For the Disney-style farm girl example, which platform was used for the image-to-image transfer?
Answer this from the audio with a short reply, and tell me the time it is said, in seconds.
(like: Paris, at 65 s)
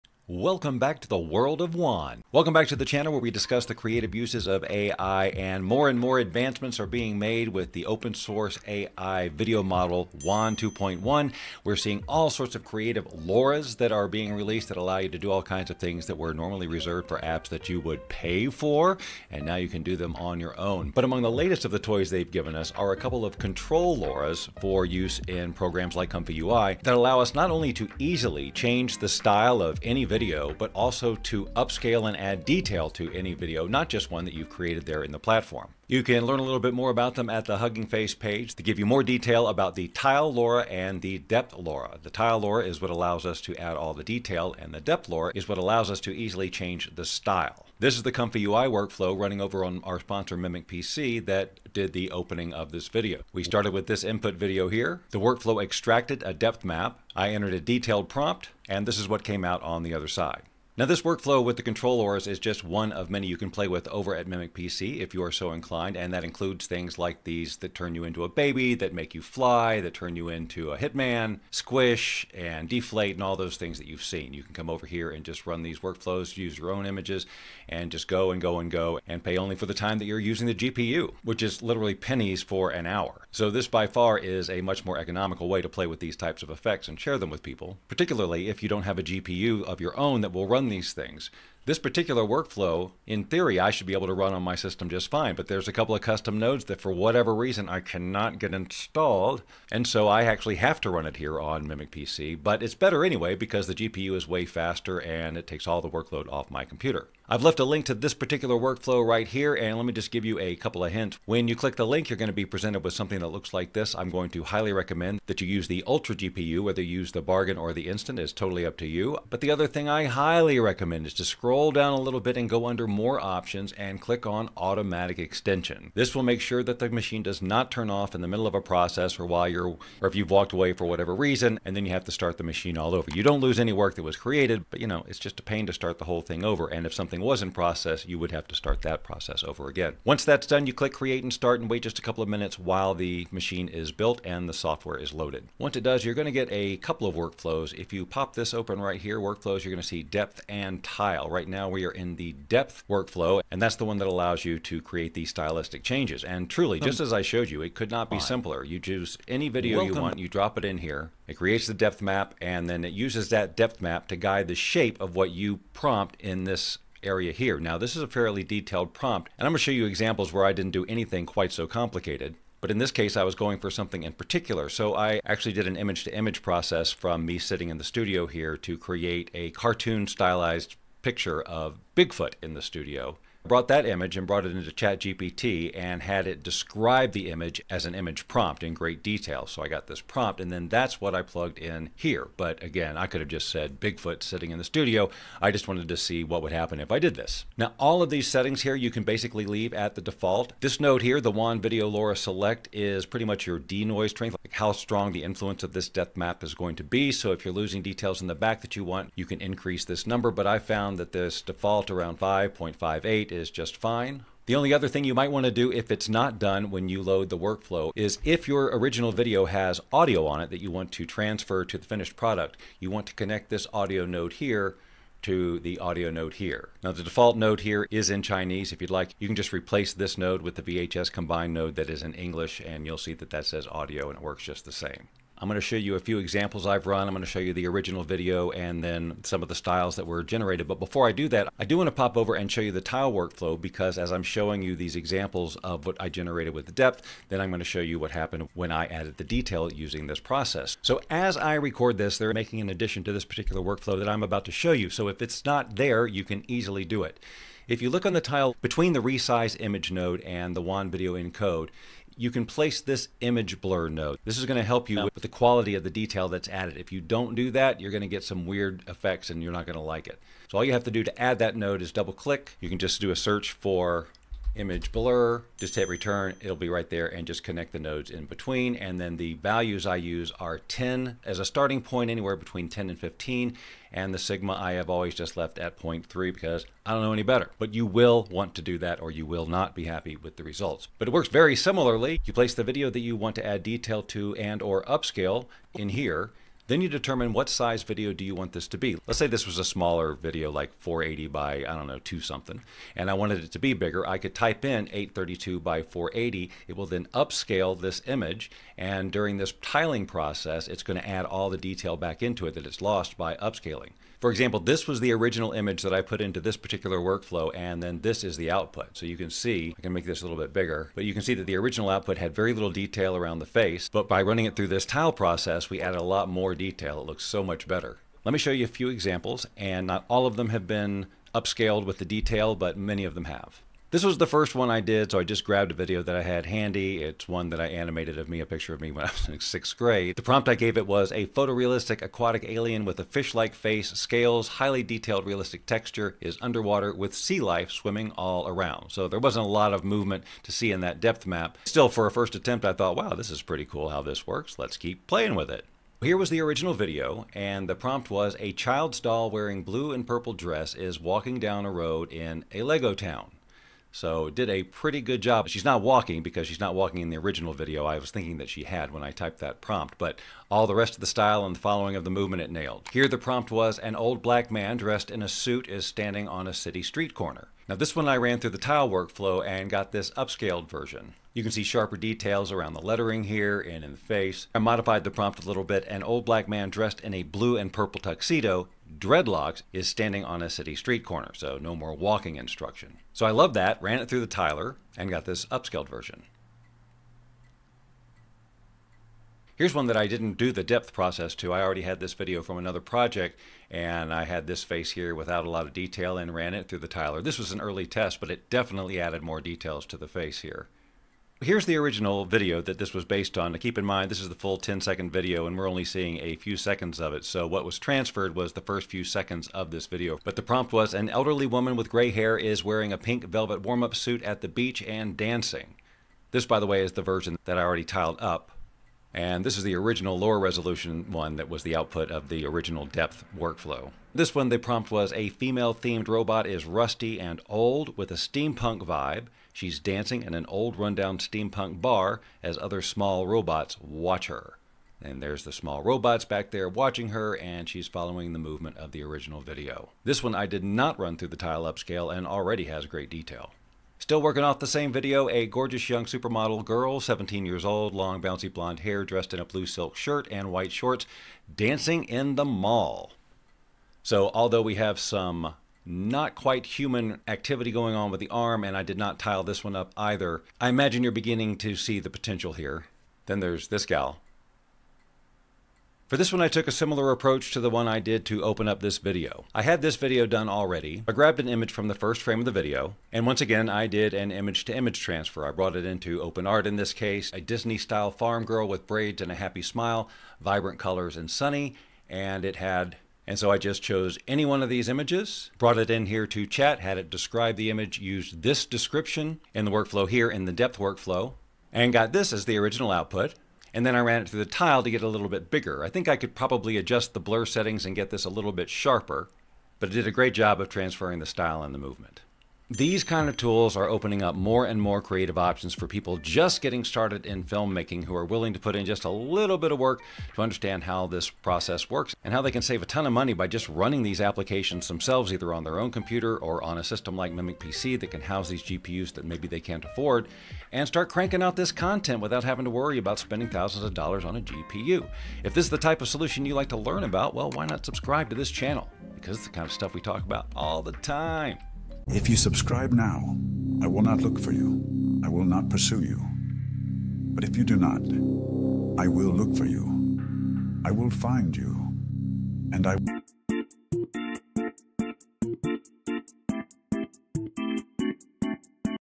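OpenArt, at 486 s.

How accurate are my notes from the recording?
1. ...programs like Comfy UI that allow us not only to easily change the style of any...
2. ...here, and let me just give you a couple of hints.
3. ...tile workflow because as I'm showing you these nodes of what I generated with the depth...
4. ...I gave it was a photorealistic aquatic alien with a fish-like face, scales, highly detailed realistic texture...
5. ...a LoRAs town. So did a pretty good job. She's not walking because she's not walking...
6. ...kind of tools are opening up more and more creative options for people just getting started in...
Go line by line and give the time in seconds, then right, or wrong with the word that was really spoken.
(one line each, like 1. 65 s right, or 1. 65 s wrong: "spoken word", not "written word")
1. 25 s right
2. 109 s right
3. 242 s wrong: "examples", not "nodes"
4. 340 s right
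5. 362 s wrong: "Lego", not "LoRAs"
6. 513 s right.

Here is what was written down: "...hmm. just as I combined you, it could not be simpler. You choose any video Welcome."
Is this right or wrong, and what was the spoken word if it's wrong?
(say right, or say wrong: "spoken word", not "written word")
wrong: "showed", not "combined".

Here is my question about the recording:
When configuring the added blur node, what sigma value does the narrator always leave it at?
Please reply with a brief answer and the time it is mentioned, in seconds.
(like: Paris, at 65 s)
0.3, at 285 s.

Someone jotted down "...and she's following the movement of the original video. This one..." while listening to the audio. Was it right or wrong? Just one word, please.
right.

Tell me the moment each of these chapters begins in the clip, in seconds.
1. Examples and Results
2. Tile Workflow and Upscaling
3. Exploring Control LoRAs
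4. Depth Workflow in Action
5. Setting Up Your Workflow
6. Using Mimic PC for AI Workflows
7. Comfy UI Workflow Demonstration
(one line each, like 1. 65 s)
1. 328 s
2. 240 s
3. 20 s
4. 151 s
5. 107 s
6. 60 s
7. 47 s.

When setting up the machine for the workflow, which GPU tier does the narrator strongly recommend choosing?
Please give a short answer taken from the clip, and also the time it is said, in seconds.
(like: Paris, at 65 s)
Ultra, at 115 s.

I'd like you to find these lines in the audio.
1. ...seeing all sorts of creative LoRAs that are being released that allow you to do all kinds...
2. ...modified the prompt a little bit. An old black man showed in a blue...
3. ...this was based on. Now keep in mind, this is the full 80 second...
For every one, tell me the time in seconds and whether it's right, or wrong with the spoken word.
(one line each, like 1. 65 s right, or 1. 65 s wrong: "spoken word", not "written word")
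1. 11 s right
2. 384 s wrong: "dressed", not "showed"
3. 412 s wrong: "10", not "80".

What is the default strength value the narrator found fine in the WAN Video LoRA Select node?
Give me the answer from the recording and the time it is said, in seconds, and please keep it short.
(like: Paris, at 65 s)
5.58, at 212 s.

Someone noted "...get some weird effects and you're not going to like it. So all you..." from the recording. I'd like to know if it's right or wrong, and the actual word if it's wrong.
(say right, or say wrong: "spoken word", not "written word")
right.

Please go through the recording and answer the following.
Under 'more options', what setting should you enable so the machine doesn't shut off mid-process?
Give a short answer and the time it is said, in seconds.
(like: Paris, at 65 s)
automatic extension, at 124 s.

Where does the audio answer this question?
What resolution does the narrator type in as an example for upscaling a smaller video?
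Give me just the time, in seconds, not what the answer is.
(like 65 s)
304 s.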